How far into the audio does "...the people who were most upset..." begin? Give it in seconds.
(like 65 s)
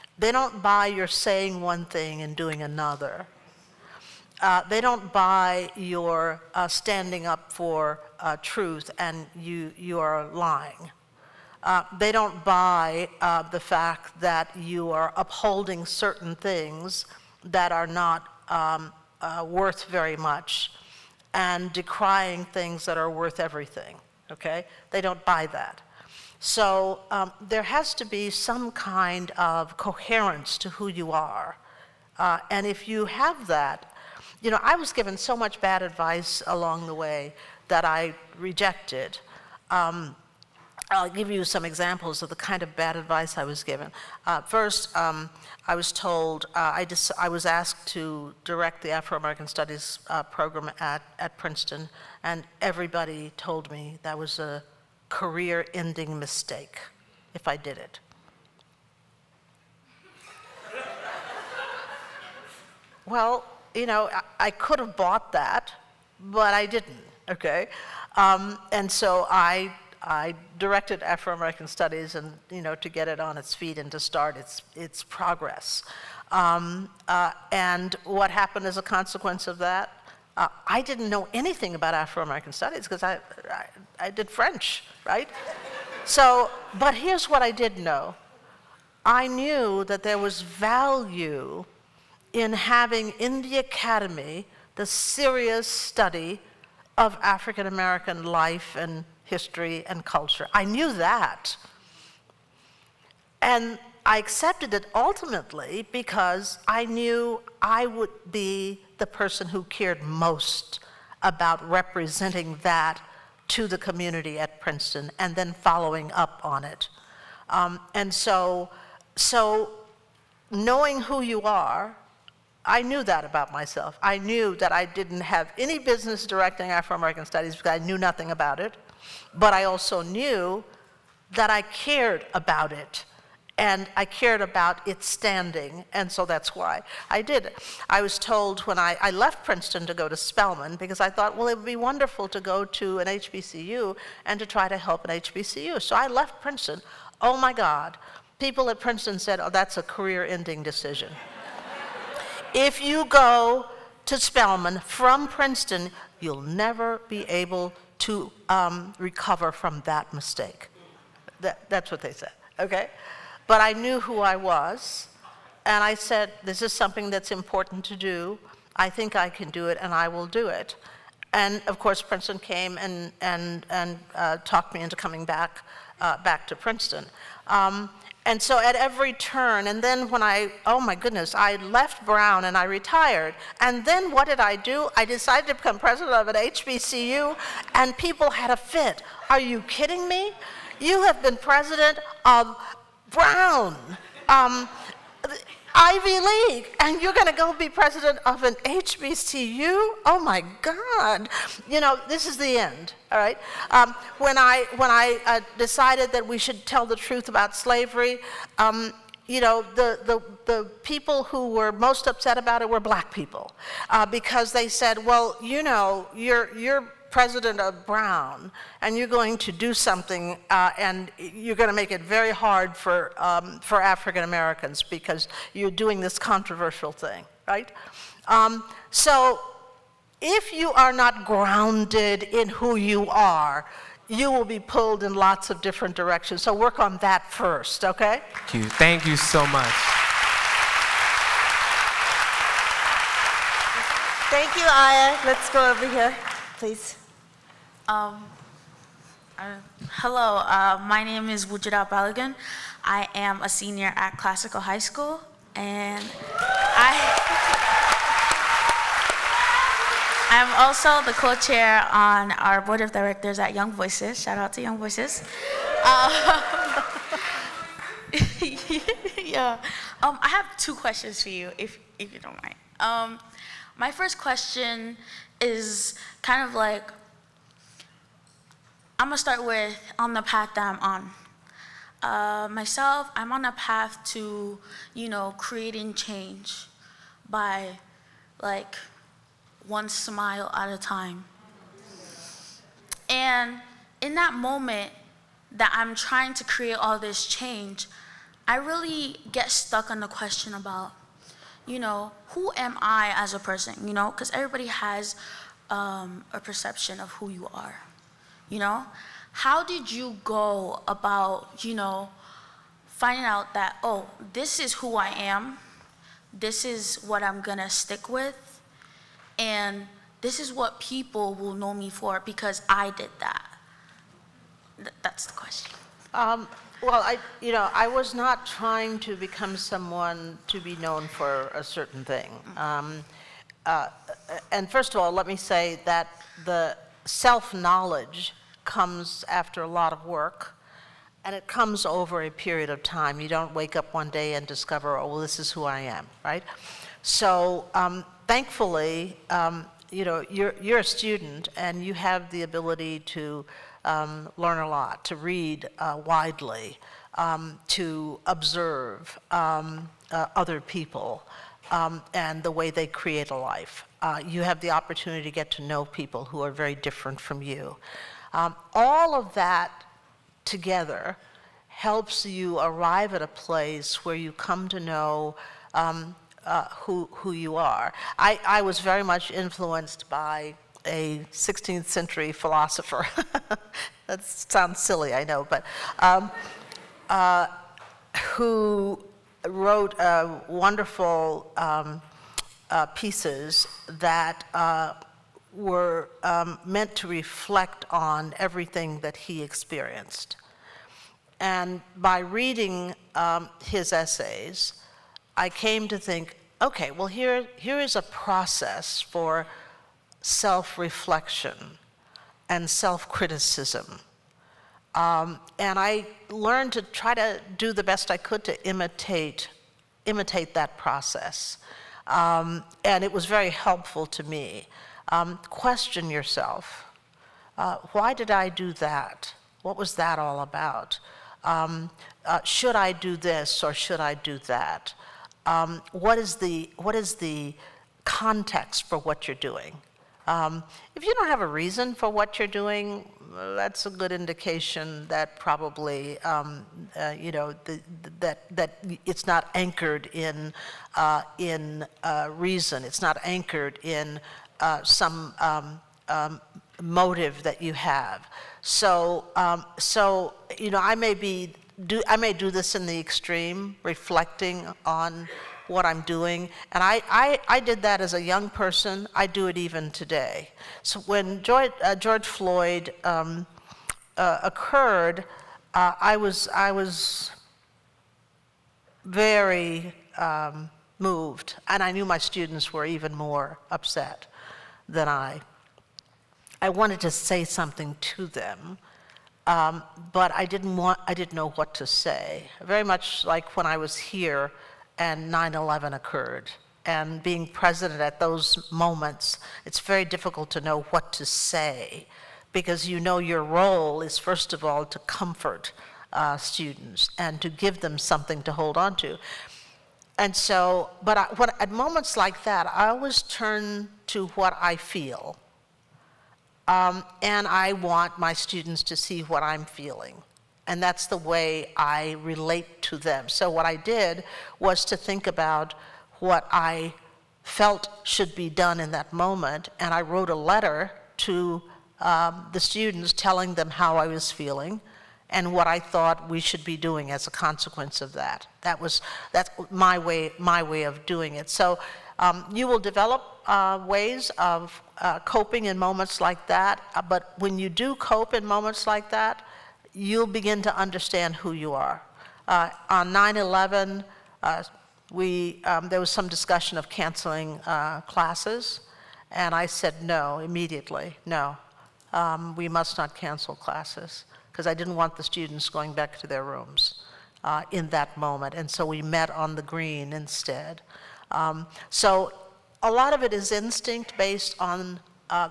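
210 s.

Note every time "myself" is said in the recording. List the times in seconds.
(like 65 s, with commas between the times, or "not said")
123 s, 282 s.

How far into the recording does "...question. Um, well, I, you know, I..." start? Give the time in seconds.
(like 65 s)
325 s.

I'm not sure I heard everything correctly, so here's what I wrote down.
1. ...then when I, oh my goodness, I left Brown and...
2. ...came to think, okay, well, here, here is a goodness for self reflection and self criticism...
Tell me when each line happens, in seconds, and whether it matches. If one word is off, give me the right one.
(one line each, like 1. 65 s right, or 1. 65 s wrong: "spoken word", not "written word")
1. 179 s right
2. 405 s wrong: "process", not "goodness".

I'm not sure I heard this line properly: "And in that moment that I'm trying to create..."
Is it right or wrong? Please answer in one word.
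right.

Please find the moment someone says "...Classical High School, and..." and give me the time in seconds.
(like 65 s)
254 s.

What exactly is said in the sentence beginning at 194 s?
Um, Ivy League, and you're going to go be president of an HBCU?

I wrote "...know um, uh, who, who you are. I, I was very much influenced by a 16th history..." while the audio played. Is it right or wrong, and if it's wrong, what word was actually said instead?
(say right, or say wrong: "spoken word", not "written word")
wrong: "century", not "history".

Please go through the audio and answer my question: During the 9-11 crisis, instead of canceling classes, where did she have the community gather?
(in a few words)
the green.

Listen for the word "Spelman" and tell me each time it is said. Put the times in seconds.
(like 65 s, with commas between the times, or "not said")
140 s, 154 s.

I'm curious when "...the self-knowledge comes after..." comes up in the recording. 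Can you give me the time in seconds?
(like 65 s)
336 s.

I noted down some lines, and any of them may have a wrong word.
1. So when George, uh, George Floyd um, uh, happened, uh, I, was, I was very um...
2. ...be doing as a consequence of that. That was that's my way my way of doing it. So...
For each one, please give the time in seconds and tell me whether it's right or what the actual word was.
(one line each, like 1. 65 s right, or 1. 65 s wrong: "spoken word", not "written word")
1. 470 s wrong: "occurred", not "happened"
2. 536 s right.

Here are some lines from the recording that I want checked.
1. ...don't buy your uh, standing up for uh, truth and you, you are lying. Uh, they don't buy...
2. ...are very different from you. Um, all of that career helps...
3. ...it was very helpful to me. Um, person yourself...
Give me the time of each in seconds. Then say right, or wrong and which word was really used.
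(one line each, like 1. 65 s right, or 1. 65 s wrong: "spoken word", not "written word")
1. 4 s right
2. 366 s wrong: "together", not "career"
3. 423 s wrong: "question", not "person".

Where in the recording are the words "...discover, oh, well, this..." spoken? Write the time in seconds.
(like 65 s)
344 s.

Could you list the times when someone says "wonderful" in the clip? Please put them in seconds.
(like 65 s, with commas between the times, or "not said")
141 s, 390 s.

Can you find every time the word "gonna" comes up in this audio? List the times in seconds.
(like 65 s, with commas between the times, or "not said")
279 s, 317 s.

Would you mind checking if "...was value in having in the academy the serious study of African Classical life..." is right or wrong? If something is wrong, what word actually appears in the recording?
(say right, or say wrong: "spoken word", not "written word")
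wrong: "American", not "Classical".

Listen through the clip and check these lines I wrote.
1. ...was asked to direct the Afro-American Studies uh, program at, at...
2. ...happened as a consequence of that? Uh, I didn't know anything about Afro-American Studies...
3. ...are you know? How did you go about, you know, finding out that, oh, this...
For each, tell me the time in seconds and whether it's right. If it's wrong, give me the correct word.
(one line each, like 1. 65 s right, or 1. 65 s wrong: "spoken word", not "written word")
1. 47 s right
2. 78 s right
3. 307 s right.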